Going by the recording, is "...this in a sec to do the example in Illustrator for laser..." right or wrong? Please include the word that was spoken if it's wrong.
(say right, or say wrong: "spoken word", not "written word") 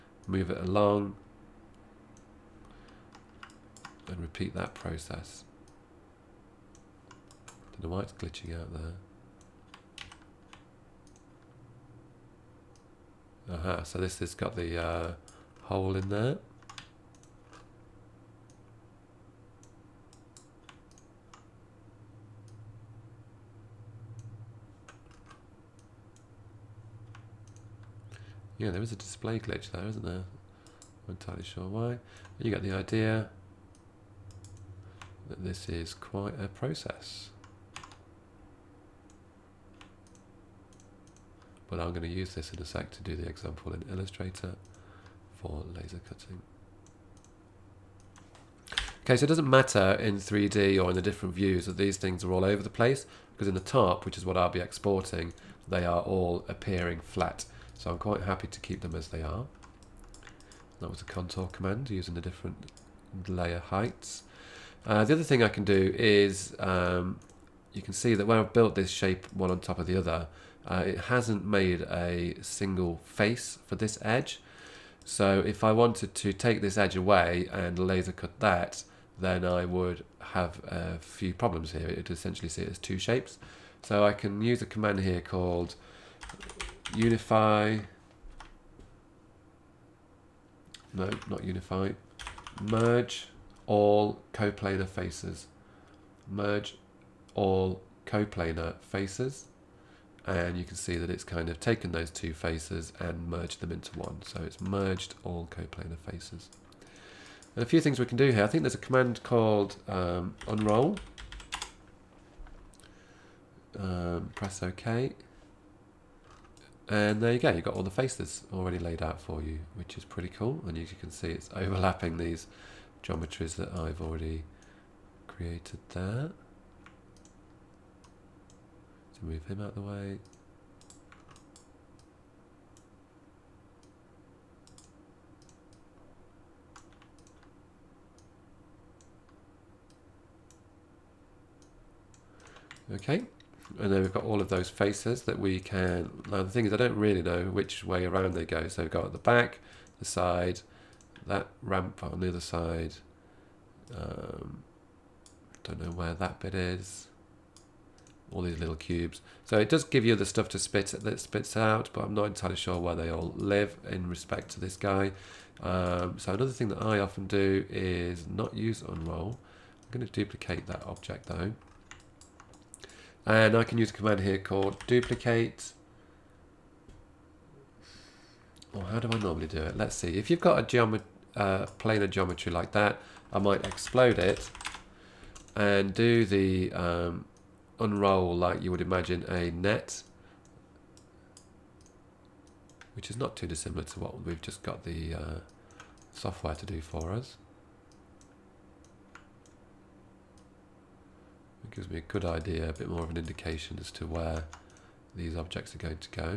right.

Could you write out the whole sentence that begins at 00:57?
So I'm quite happy to keep them as they are.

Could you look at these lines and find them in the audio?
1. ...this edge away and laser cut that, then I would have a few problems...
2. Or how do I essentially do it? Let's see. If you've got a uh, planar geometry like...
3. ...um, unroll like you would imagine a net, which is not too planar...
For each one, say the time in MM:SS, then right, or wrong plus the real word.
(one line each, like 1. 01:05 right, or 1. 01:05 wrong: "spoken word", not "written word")
1. 01:16 right
2. 02:58 wrong: "normally", not "essentially"
3. 03:06 wrong: "dissimilar", not "planar".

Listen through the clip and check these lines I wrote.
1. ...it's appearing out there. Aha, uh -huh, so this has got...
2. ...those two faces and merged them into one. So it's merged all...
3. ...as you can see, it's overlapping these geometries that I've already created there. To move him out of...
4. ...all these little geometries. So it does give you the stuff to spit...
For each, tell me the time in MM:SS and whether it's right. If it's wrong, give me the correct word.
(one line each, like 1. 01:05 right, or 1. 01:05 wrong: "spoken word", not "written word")
1. 00:08 wrong: "glitching", not "appearing"
2. 01:41 right
3. 02:00 right
4. 02:38 wrong: "cubes", not "geometries".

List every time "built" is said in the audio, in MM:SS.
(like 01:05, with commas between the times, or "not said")
01:08.